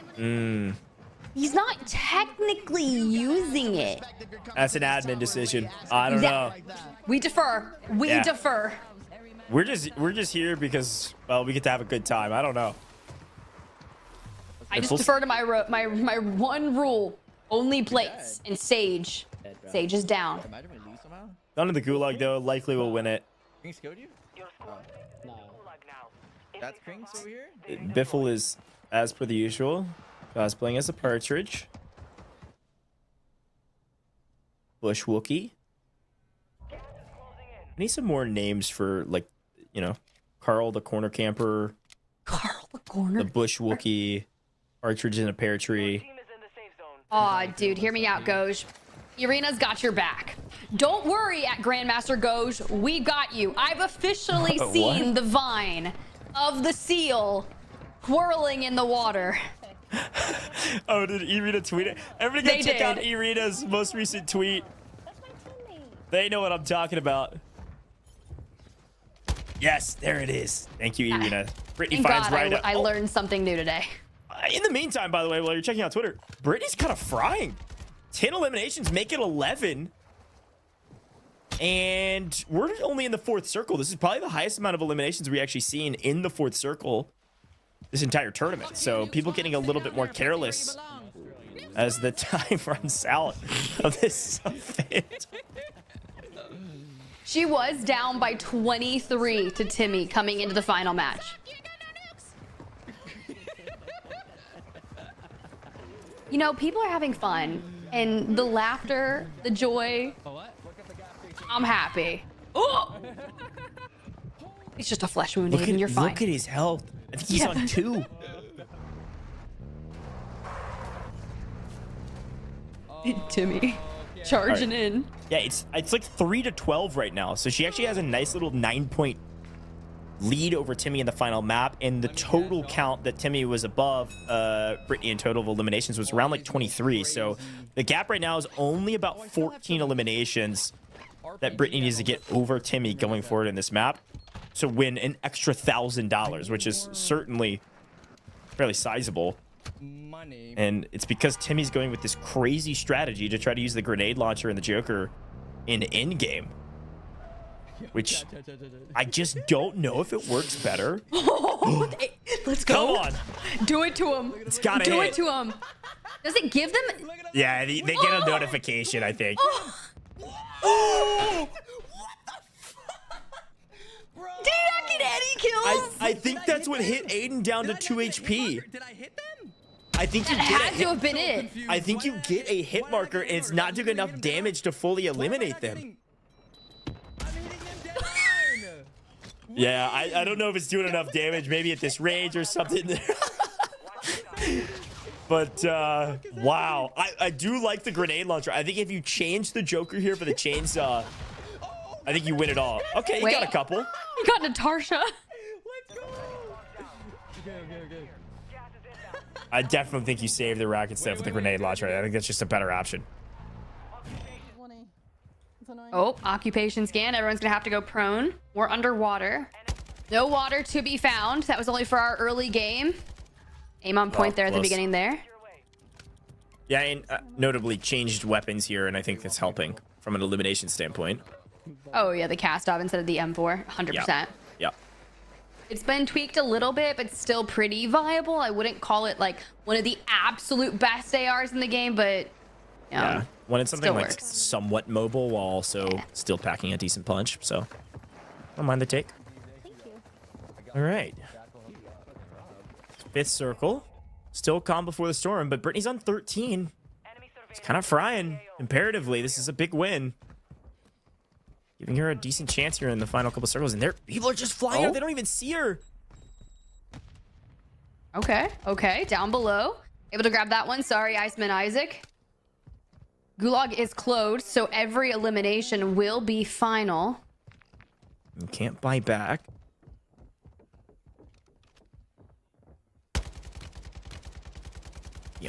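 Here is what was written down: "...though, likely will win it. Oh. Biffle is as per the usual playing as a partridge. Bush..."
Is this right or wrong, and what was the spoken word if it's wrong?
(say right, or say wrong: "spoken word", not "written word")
right.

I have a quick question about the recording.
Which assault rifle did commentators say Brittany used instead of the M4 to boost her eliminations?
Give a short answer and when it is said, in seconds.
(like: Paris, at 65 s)
Kastov, at 232 s.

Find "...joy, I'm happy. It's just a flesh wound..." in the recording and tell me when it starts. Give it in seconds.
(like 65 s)
109 s.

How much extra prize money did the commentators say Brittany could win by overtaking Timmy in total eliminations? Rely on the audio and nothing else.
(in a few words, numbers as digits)
$1,000.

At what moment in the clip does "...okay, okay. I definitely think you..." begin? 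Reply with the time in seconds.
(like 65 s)
207 s.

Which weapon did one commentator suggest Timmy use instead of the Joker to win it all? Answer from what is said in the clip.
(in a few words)
chainsaw.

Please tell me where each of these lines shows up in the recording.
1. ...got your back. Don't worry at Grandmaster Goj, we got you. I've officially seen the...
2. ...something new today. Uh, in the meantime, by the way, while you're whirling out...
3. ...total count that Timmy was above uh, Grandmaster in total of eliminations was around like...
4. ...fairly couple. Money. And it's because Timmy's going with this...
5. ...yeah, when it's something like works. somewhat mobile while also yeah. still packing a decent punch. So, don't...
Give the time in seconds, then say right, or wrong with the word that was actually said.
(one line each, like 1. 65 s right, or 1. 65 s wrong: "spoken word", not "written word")
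1. 49 s right
2. 73 s wrong: "checking", not "whirling"
3. 132 s wrong: "Brittany", not "Grandmaster"
4. 148 s wrong: "sizable", not "couple"
5. 242 s right.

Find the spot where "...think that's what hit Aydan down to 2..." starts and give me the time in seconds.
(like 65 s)
176 s.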